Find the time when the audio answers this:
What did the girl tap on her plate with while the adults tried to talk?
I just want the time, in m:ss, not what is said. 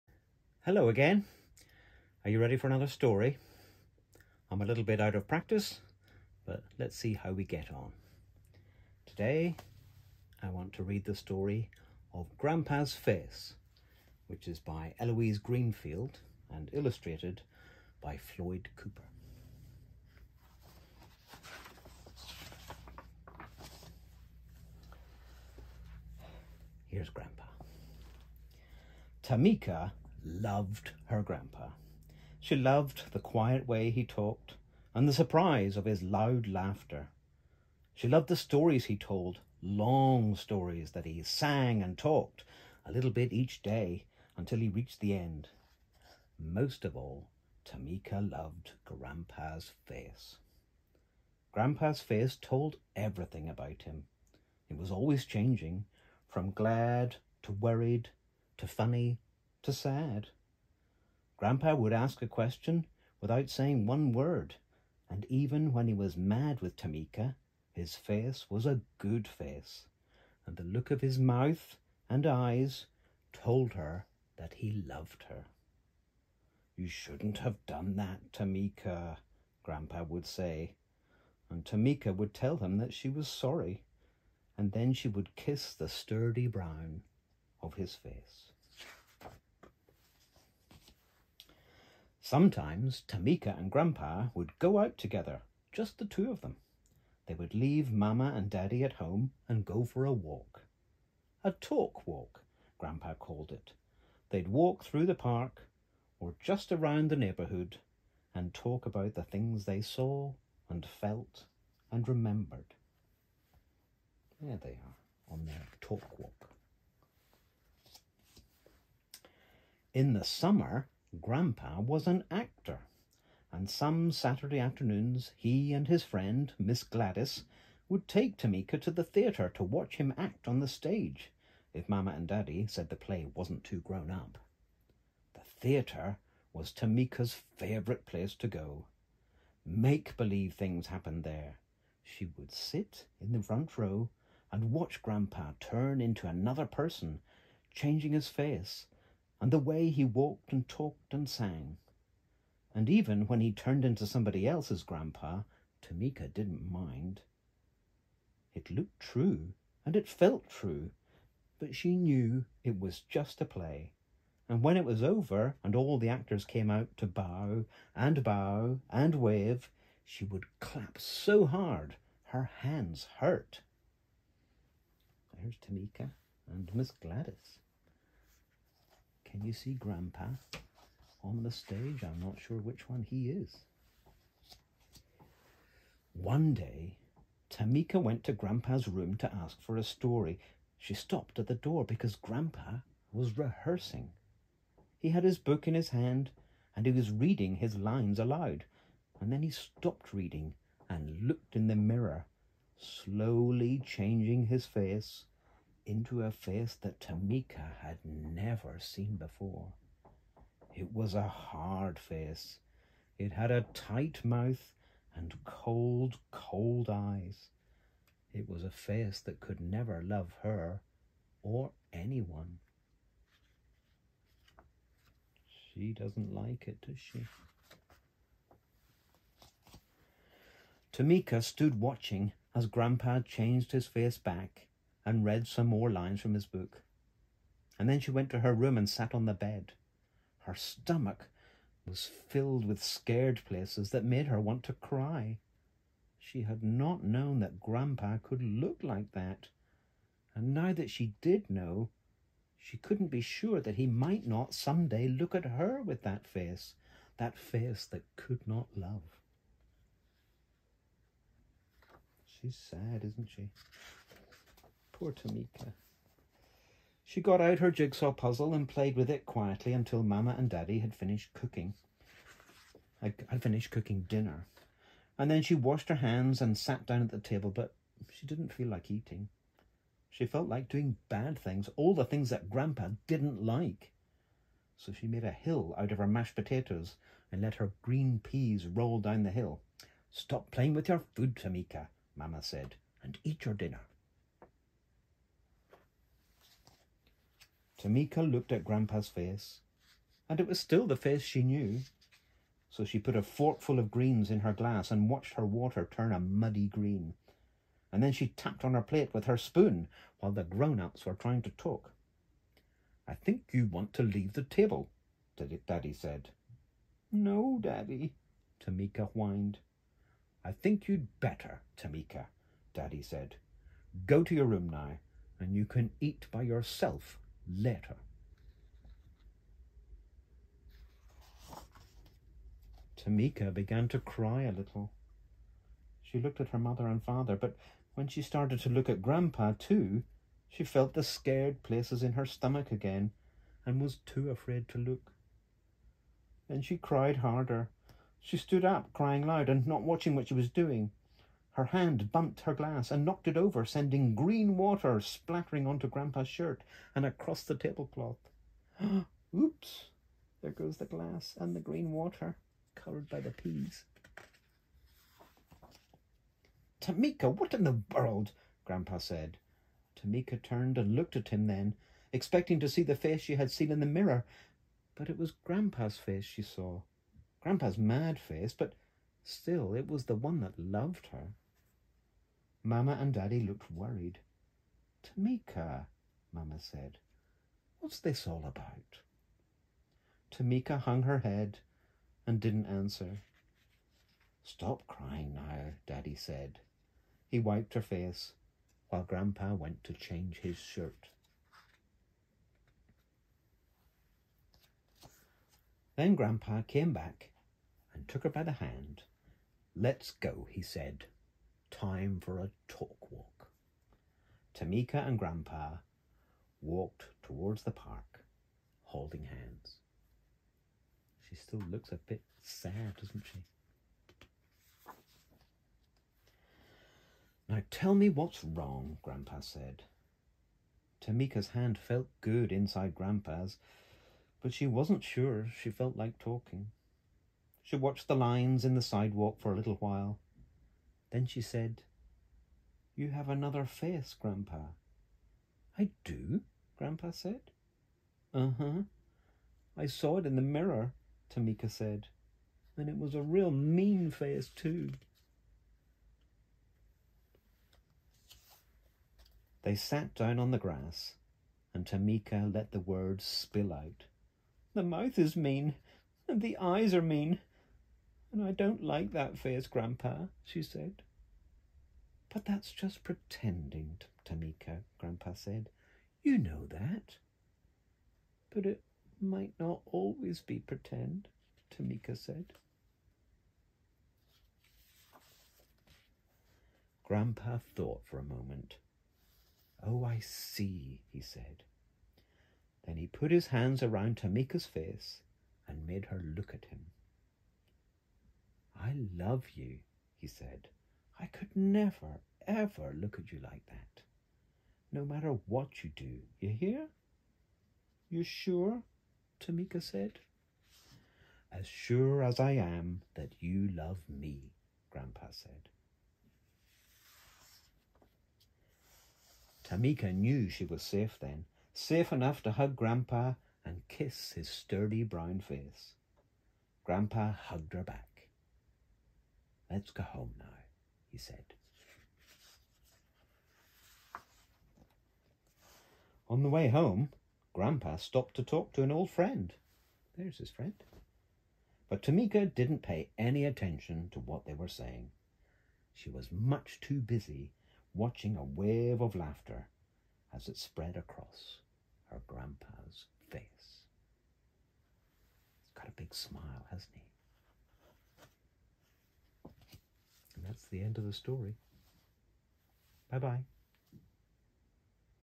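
5:09.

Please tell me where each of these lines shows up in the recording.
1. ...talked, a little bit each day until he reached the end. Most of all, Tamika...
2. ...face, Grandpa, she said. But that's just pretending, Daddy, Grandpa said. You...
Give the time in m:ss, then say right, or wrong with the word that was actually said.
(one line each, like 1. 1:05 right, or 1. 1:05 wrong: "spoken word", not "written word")
1. 0:41 right
2. 7:49 wrong: "Tamika", not "Daddy".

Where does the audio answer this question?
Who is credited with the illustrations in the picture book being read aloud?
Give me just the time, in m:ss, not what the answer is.
0:18.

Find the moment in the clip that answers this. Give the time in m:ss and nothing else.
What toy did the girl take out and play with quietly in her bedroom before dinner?
4:27.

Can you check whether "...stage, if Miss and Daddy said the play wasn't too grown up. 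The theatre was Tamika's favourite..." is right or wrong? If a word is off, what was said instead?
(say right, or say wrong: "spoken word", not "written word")
wrong: "Mama", not "Miss".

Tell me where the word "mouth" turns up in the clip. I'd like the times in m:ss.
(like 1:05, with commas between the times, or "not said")
1:11, 3:34, 7:44.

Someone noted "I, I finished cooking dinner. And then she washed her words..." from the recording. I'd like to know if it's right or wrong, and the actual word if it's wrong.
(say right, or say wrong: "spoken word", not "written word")
wrong: "hands", not "words".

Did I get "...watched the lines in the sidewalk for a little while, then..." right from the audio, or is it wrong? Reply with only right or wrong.
right.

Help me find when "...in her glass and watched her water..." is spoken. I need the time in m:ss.
5:04.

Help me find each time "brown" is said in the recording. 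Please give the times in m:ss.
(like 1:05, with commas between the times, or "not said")
1:26, 8:45.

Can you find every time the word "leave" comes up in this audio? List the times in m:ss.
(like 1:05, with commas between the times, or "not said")
1:37, 5:14.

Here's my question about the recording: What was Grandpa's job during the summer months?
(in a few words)
Actor.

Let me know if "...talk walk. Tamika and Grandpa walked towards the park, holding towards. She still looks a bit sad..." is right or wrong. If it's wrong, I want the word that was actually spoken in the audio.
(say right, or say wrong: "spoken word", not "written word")
wrong: "hands", not "towards".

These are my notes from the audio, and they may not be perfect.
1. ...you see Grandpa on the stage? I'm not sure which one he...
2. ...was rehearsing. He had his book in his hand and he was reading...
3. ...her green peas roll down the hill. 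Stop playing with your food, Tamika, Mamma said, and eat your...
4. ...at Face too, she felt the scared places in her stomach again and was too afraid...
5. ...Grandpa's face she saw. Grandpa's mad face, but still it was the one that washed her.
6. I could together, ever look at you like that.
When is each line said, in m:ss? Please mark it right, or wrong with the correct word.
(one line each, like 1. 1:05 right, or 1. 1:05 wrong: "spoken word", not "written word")
1. 2:59 right
2. 3:13 right
3. 4:47 right
4. 5:38 wrong: "Grandpa", not "Face"
5. 6:15 wrong: "loved", not "washed"
6. 8:21 wrong: "never", not "together".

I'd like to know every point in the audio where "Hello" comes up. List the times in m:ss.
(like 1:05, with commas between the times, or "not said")
0:00.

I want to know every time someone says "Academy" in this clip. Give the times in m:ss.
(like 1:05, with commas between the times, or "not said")
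not said.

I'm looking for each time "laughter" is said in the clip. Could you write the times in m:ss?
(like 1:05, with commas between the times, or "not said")
0:36, 9:09.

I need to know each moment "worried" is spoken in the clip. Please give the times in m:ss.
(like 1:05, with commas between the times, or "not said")
0:57, 6:23.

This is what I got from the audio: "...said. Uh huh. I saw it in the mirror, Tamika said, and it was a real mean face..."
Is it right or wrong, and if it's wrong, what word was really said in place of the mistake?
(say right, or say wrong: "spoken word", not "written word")
right.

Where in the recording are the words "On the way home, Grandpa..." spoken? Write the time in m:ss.
8:56.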